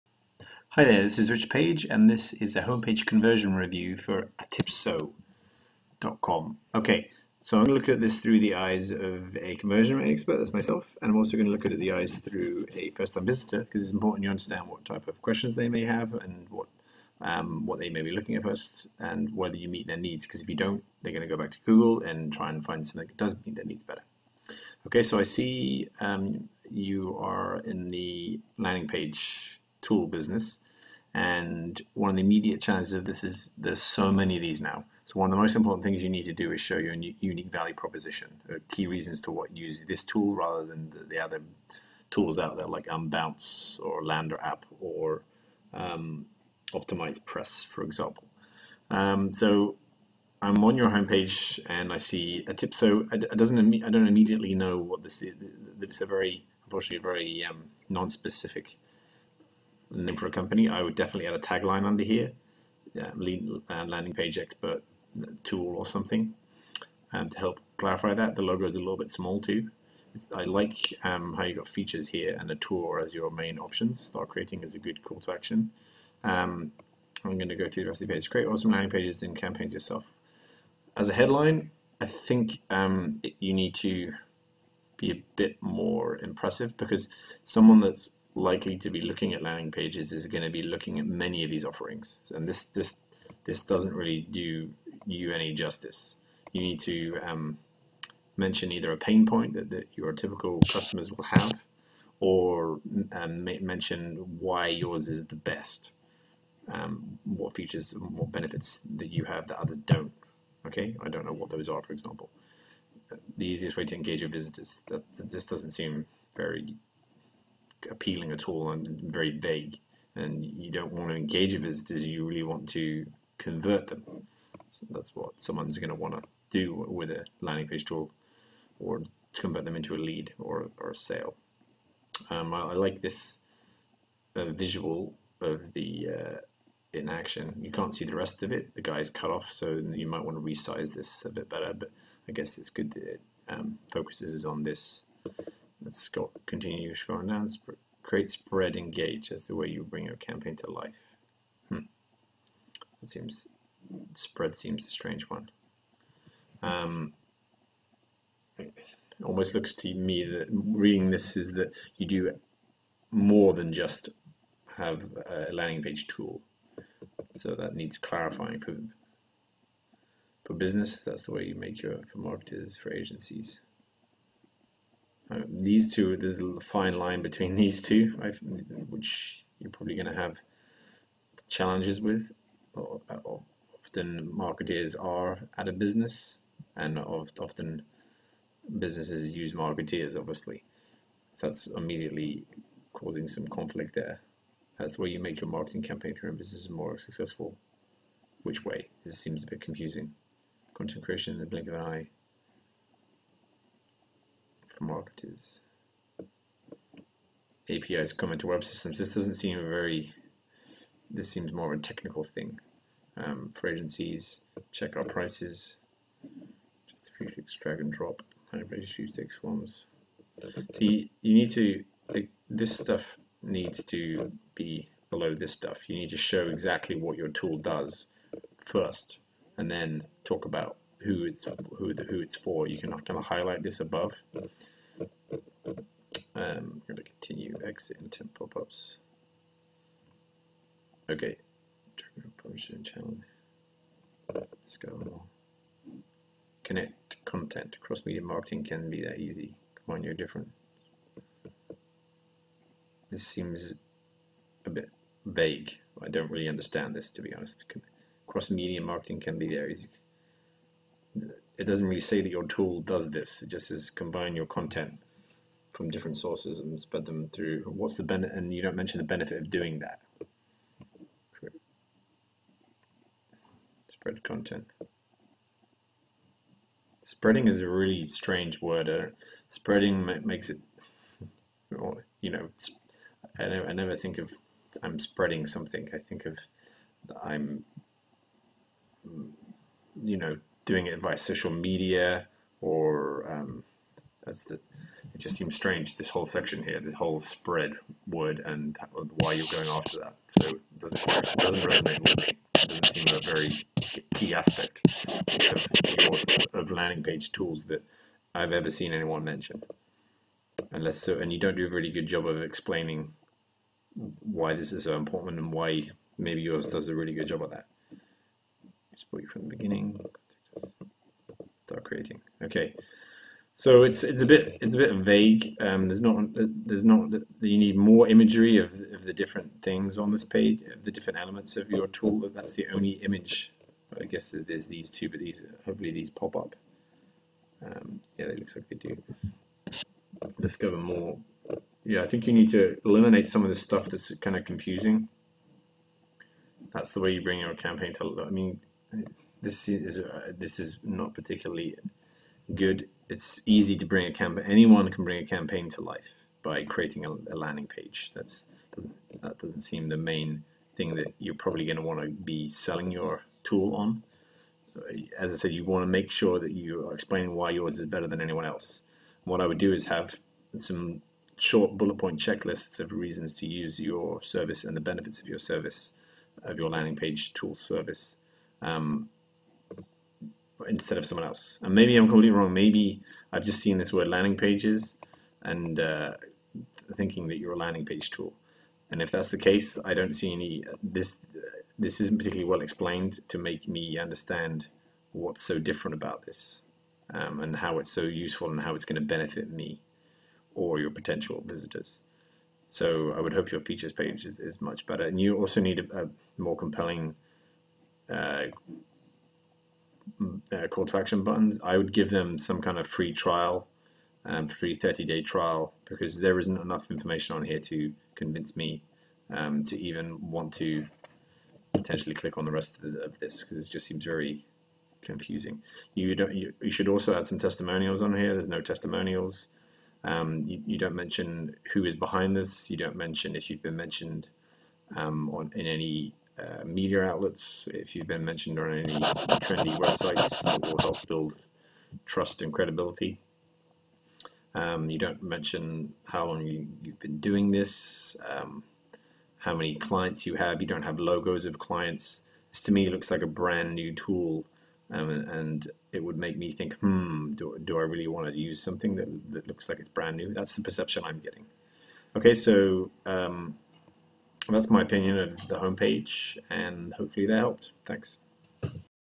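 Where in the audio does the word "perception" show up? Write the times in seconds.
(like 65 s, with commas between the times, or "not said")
460 s.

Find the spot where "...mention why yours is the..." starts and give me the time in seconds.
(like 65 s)
103 s.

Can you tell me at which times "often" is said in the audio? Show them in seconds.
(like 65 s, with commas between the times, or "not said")
182 s, 186 s.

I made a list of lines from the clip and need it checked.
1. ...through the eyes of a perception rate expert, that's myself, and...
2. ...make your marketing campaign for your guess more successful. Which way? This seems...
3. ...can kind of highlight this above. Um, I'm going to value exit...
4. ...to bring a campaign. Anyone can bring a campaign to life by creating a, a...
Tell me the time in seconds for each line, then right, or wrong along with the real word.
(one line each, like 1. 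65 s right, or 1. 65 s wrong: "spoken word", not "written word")
1. 8 s wrong: "conversion", not "perception"
2. 195 s wrong: "business", not "guess"
3. 232 s wrong: "continue", not "value"
4. 353 s right.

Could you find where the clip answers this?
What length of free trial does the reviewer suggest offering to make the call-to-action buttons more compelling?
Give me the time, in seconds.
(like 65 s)
414 s.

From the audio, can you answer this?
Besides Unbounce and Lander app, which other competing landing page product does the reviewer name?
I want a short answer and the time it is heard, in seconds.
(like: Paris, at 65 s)
Optimize Press, at 46 s.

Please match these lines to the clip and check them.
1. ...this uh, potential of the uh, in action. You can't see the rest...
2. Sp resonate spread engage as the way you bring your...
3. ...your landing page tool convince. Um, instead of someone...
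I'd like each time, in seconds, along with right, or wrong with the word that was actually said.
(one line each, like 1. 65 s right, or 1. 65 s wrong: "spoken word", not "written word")
1. 133 s wrong: "visual", not "potential"
2. 147 s wrong: "create", not "resonate"
3. 376 s wrong: "service", not "convince".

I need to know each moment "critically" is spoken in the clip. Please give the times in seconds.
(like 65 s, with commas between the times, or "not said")
not said.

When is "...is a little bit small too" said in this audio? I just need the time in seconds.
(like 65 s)
68 s.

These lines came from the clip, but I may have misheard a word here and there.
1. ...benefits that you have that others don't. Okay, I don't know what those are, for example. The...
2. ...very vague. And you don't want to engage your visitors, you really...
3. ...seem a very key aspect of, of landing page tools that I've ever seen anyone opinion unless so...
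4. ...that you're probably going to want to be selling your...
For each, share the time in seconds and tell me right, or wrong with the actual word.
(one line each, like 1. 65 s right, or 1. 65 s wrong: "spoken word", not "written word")
1. 108 s right
2. 119 s right
3. 302 s wrong: "mention", not "opinion"
4. 360 s right.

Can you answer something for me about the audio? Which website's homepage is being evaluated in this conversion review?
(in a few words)
atipso.com.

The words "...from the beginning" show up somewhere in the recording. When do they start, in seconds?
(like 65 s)
319 s.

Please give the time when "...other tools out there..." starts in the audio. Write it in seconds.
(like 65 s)
41 s.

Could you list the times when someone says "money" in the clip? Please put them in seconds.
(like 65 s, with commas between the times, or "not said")
not said.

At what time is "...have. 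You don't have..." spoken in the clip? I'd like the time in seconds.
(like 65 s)
450 s.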